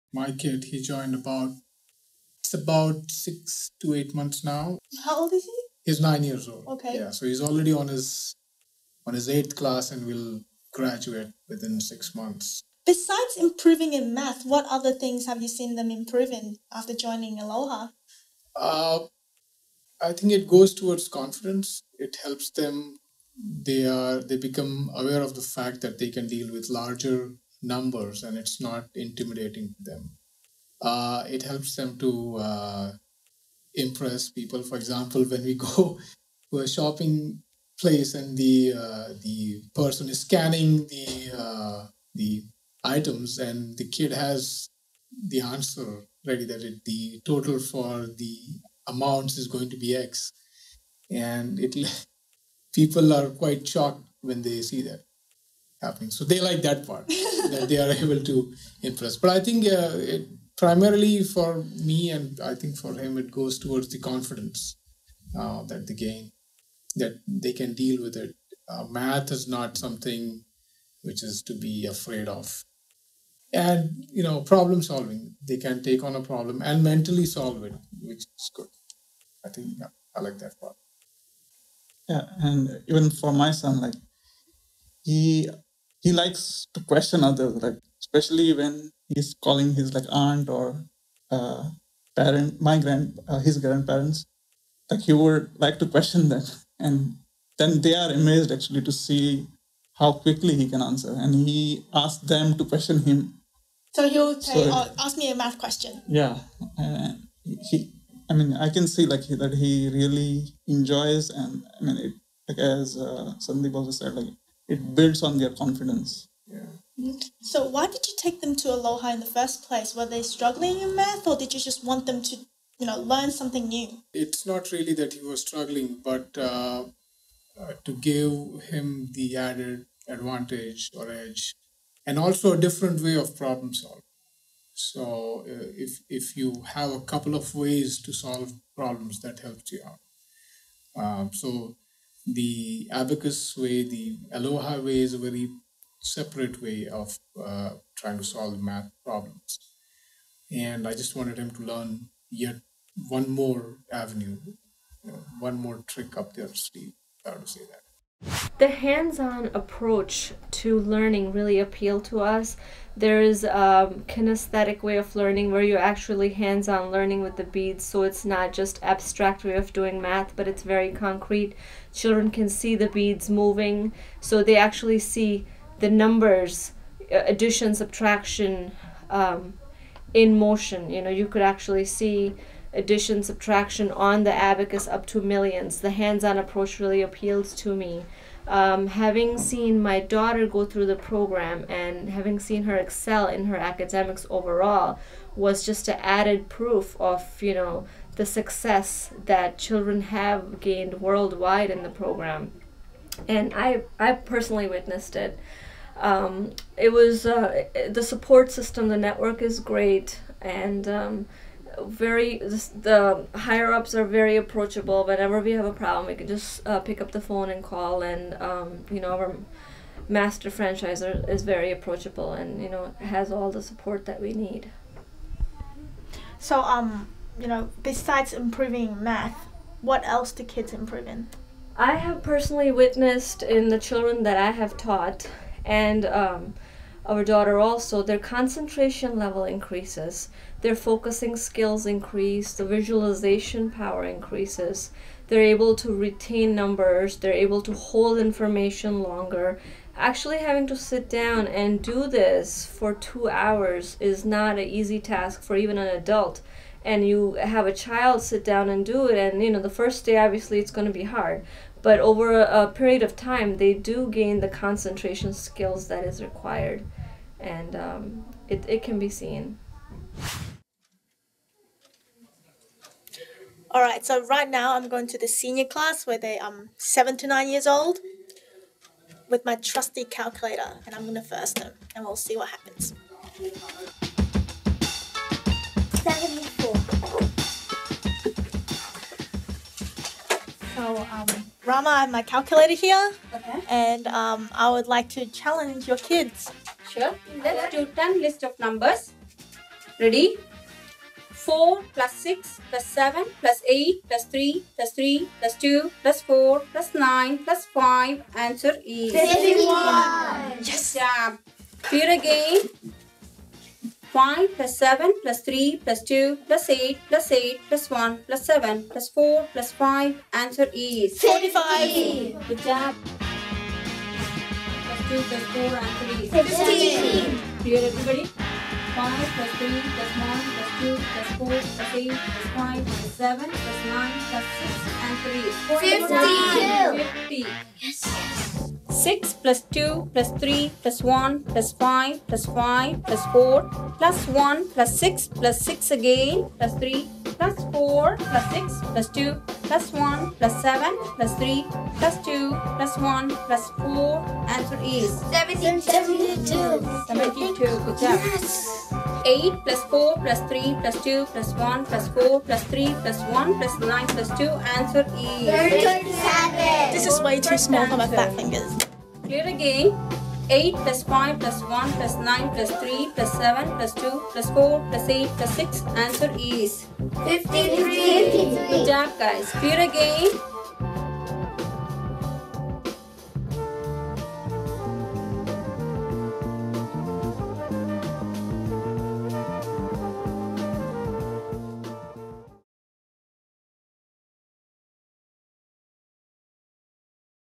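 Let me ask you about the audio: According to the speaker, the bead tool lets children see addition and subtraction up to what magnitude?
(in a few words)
millions.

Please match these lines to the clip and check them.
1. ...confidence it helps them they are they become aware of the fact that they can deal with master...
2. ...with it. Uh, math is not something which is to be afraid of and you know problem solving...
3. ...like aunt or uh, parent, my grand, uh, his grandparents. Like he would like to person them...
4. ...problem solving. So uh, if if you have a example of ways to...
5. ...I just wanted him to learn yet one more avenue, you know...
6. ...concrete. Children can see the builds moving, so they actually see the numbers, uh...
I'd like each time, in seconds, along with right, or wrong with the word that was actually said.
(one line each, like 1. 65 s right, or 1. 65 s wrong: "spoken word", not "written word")
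1. 21 s wrong: "larger", not "master"
2. 68 s right
3. 89 s wrong: "question", not "person"
4. 133 s wrong: "couple", not "example"
5. 150 s right
6. 170 s wrong: "beads", not "builds".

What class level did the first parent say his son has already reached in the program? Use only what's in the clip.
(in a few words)
8th class.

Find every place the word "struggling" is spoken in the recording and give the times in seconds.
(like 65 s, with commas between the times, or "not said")
120 s, 125 s.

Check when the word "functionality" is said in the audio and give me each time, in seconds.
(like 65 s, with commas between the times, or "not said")
not said.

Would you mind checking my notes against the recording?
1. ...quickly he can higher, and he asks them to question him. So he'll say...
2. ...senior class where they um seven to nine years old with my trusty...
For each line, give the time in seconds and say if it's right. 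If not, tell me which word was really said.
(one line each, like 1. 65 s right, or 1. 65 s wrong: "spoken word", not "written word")
1. 100 s wrong: "answer", not "higher"
2. 275 s right.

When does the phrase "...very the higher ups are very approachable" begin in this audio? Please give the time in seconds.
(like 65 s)
211 s.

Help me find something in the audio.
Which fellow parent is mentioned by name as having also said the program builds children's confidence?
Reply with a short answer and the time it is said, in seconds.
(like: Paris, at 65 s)
Sandeep, at 113 s.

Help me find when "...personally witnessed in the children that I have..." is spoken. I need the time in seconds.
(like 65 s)
232 s.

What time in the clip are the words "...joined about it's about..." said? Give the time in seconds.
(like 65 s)
0 s.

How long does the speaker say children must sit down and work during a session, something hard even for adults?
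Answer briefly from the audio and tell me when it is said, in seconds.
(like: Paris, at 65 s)
2 hours, at 252 s.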